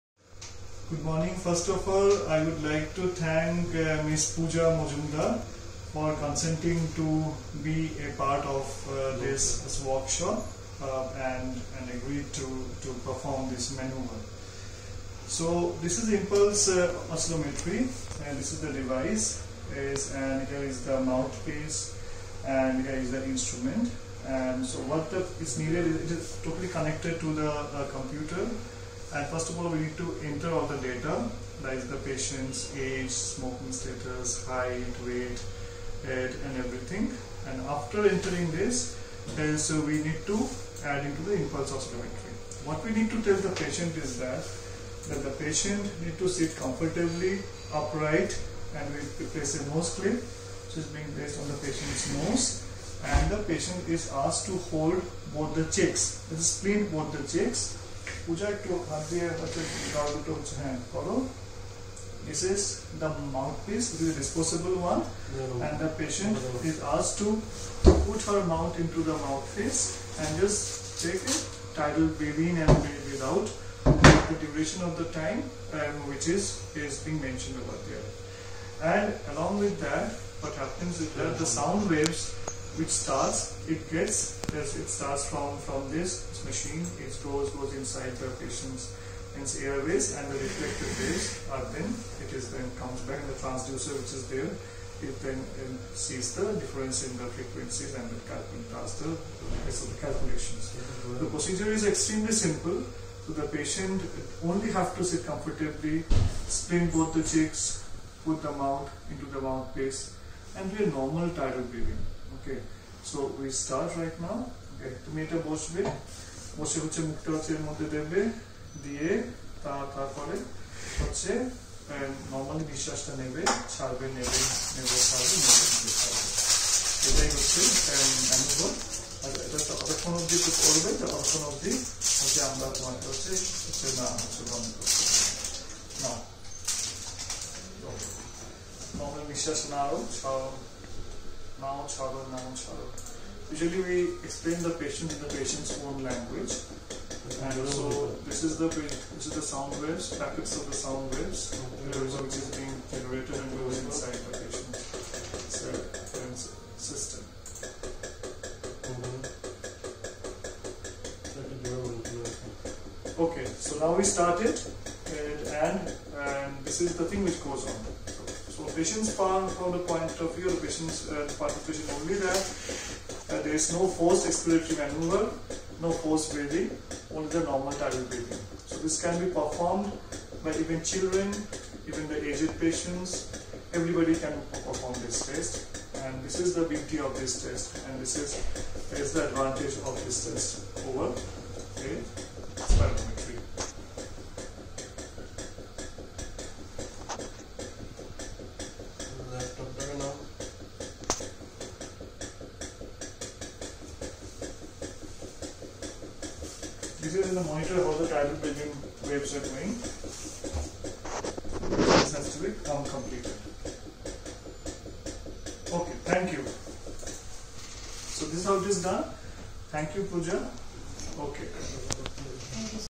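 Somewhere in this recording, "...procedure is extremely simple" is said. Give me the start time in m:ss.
1:41.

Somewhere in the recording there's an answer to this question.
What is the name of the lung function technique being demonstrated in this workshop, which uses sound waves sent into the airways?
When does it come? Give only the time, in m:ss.
0:16.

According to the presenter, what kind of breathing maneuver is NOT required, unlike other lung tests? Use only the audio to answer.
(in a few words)
Forced expiratory maneuver.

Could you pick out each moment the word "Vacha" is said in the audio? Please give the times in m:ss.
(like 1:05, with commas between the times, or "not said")
0:59.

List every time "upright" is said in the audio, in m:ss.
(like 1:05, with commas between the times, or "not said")
0:47.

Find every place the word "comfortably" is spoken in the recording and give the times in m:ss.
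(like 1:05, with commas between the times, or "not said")
0:46, 1:45.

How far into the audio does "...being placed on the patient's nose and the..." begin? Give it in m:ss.
0:50.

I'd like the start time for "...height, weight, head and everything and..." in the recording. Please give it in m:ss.
0:34.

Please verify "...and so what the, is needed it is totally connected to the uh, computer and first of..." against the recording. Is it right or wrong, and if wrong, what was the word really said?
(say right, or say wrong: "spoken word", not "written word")
right.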